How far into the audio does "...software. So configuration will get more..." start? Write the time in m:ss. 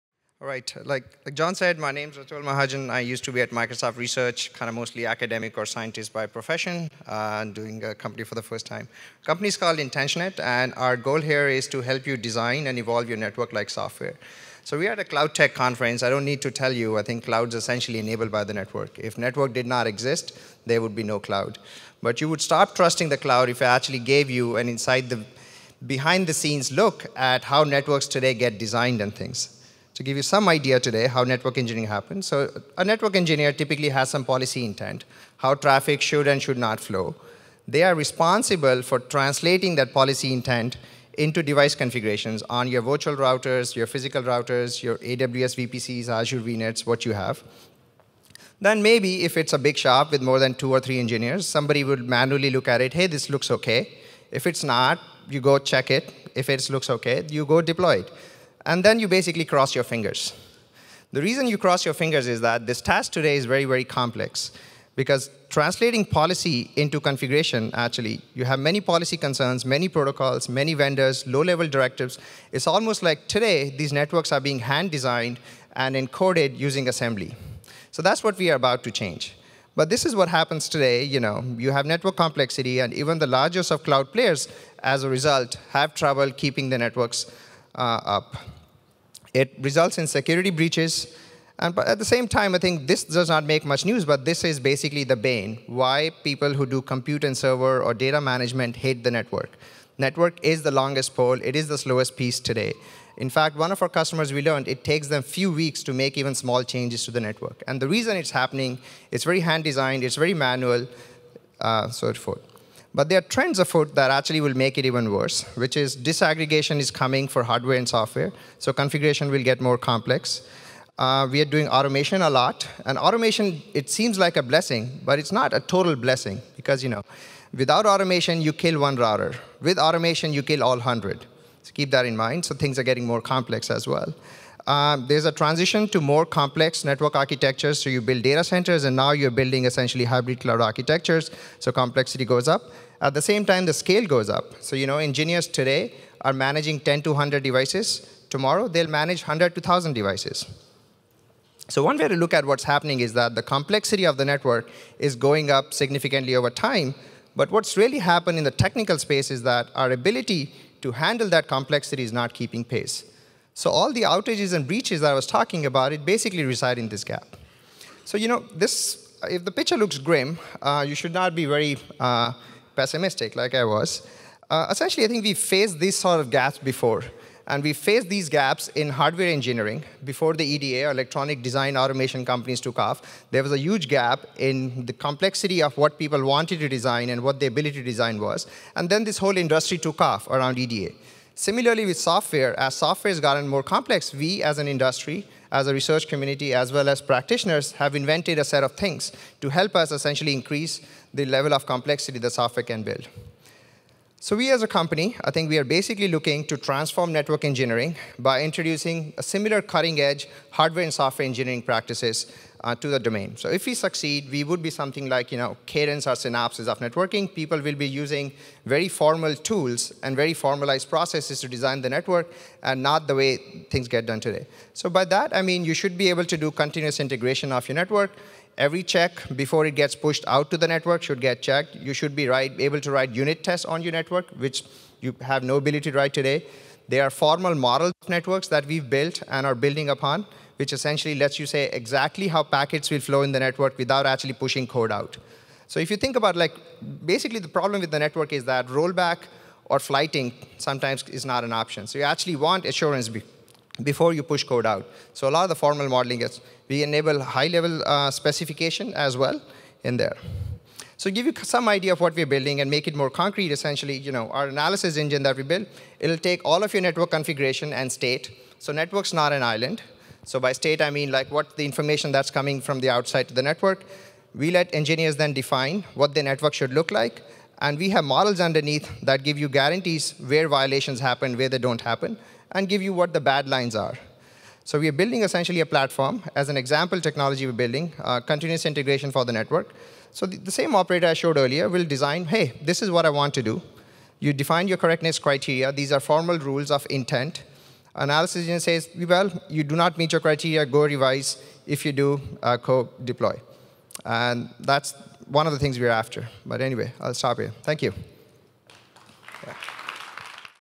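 1:57.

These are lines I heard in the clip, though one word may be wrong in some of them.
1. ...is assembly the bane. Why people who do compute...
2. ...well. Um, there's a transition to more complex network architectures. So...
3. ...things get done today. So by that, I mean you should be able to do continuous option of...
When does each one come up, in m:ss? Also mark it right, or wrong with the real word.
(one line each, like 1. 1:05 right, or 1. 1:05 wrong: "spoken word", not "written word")
1. 1:34 wrong: "basically", not "assembly"
2. 2:13 right
3. 3:43 wrong: "integration", not "option".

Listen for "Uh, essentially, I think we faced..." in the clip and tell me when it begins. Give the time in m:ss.
2:54.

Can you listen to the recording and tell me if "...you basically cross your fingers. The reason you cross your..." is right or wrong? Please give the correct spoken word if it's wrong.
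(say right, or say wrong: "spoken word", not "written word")
right.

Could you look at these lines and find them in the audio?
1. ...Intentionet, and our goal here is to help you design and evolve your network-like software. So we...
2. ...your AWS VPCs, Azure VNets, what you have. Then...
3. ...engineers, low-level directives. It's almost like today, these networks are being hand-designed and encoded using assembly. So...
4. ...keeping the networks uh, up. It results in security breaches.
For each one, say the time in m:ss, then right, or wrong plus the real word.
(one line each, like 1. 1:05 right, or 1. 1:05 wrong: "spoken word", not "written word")
1. 0:09 right
2. 0:44 right
3. 1:10 wrong: "vendors", not "engineers"
4. 1:26 right.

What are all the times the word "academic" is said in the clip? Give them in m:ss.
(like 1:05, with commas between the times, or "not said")
0:05.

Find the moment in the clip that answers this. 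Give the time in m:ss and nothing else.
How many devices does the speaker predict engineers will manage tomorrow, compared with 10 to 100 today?
2:29.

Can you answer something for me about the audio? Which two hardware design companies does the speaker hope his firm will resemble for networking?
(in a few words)
Cadence or Synopsys.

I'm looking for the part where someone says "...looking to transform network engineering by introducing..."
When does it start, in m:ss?
3:26.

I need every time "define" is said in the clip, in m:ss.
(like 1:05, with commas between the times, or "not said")
4:35, 4:54.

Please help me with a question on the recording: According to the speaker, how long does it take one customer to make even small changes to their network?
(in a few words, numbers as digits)
few weeks.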